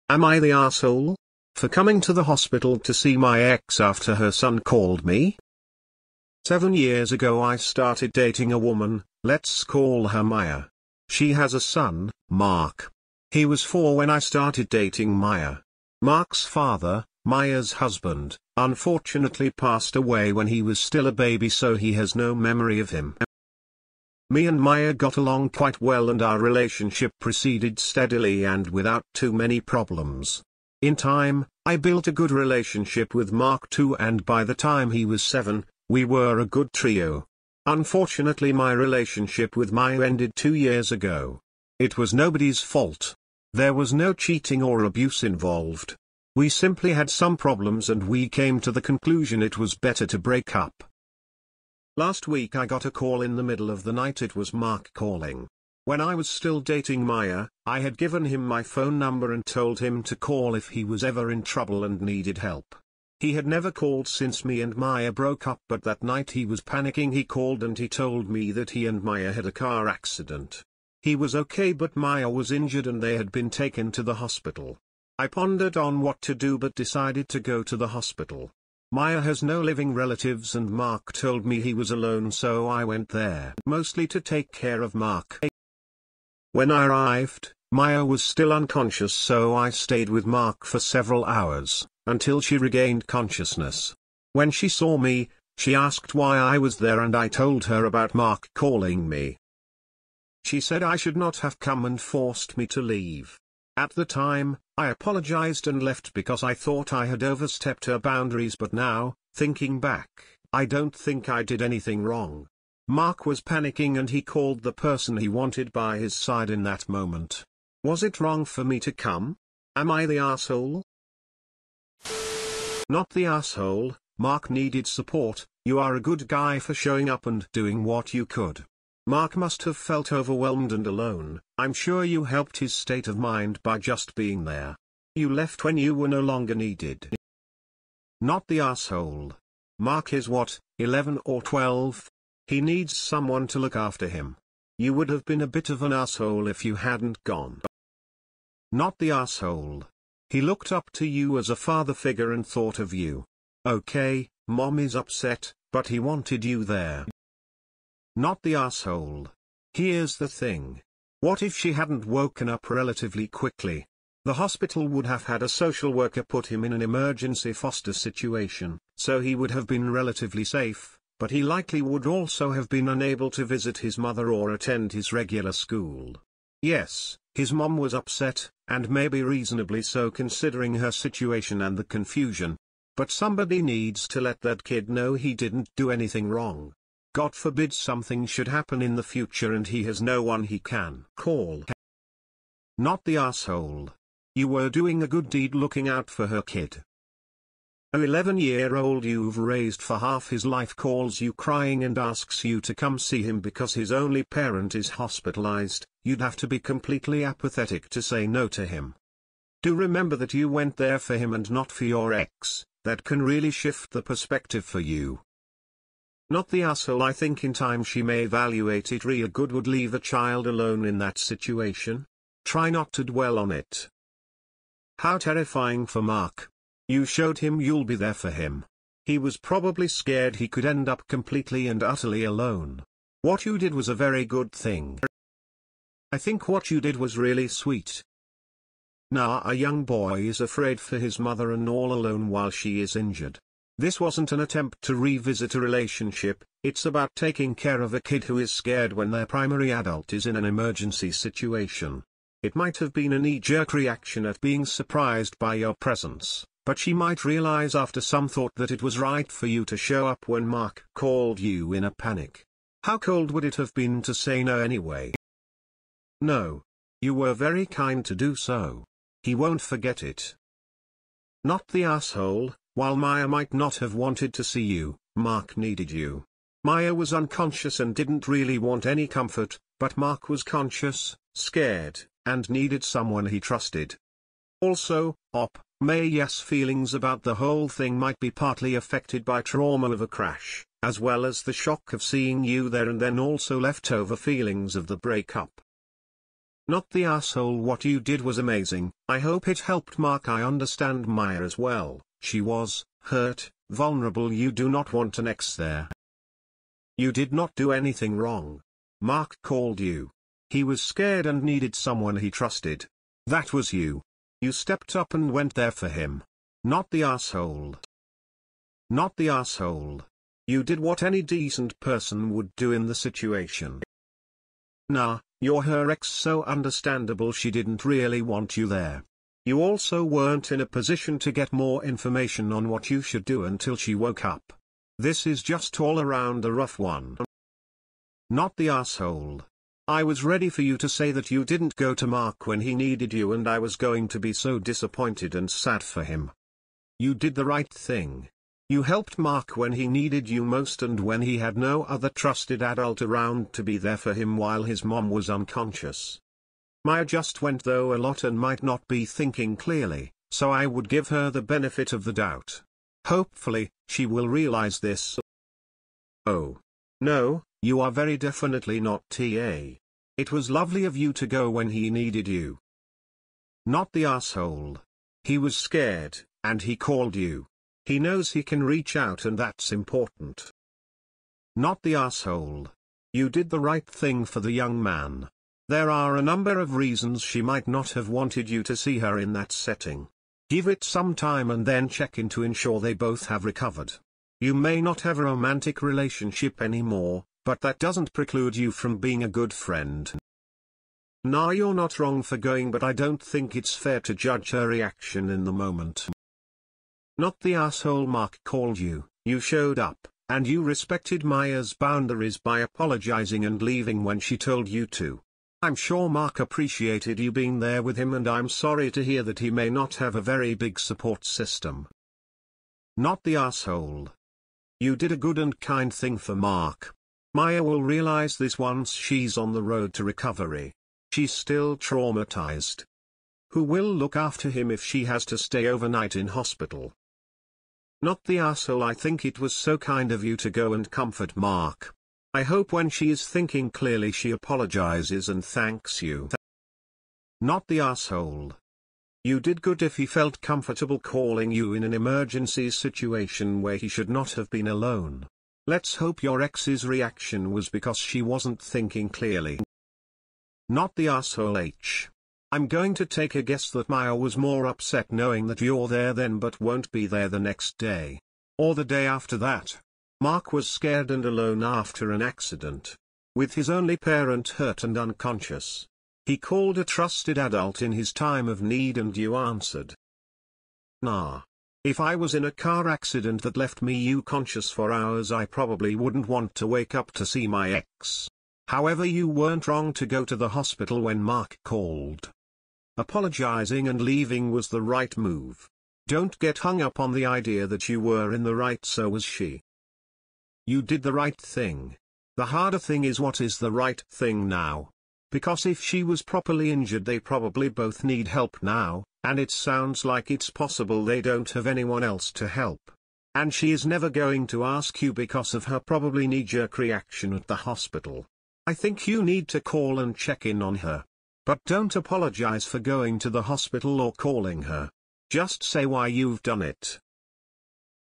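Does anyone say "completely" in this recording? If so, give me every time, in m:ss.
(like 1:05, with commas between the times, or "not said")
3:26, 3:51.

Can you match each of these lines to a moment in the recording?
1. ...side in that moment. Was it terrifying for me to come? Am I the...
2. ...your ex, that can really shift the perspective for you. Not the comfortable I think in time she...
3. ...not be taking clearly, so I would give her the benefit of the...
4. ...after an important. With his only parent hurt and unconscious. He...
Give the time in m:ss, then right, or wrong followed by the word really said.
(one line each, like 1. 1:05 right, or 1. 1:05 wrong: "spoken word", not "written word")
1. 1:56 wrong: "wrong", not "terrifying"
2. 3:31 wrong: "asshole", not "comfortable"
3. 5:58 wrong: "thinking", not "taking"
4. 7:51 wrong: "accident", not "important".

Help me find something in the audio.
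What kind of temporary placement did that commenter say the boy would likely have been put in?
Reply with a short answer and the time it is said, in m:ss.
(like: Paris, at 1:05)
Emergency foster situation, at 2:46.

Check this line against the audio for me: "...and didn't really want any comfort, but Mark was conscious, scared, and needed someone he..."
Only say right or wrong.
right.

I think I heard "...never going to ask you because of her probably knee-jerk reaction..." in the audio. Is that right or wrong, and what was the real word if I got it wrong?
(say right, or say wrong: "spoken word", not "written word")
right.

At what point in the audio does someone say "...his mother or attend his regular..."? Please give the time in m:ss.
2:53.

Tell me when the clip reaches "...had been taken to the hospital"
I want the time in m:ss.
1:13.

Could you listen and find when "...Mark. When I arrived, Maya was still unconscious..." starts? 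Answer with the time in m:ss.
1:24.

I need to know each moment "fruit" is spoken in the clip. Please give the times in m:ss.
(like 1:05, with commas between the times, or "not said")
not said.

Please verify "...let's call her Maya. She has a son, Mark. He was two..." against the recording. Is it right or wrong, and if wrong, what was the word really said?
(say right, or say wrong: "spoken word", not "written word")
wrong: "four", not "two".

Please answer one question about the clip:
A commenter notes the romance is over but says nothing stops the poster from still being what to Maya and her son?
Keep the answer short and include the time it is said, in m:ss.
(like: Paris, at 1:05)
A good friend, at 6:39.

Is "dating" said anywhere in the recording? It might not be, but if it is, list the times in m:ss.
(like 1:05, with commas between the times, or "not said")
0:08, 0:14, 0:56.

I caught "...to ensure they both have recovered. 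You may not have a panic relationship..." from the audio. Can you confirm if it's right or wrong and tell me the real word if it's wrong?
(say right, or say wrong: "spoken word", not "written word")
wrong: "romantic", not "panic".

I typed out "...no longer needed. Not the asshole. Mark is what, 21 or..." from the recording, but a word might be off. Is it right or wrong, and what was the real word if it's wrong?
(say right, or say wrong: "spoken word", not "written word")
wrong: "11", not "21".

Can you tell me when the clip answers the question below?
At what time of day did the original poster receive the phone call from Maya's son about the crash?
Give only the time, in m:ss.
0:53.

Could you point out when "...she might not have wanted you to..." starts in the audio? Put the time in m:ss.
6:27.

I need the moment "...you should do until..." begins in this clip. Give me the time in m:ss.
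5:32.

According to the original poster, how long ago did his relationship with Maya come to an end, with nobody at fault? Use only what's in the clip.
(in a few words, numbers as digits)
Two years ago.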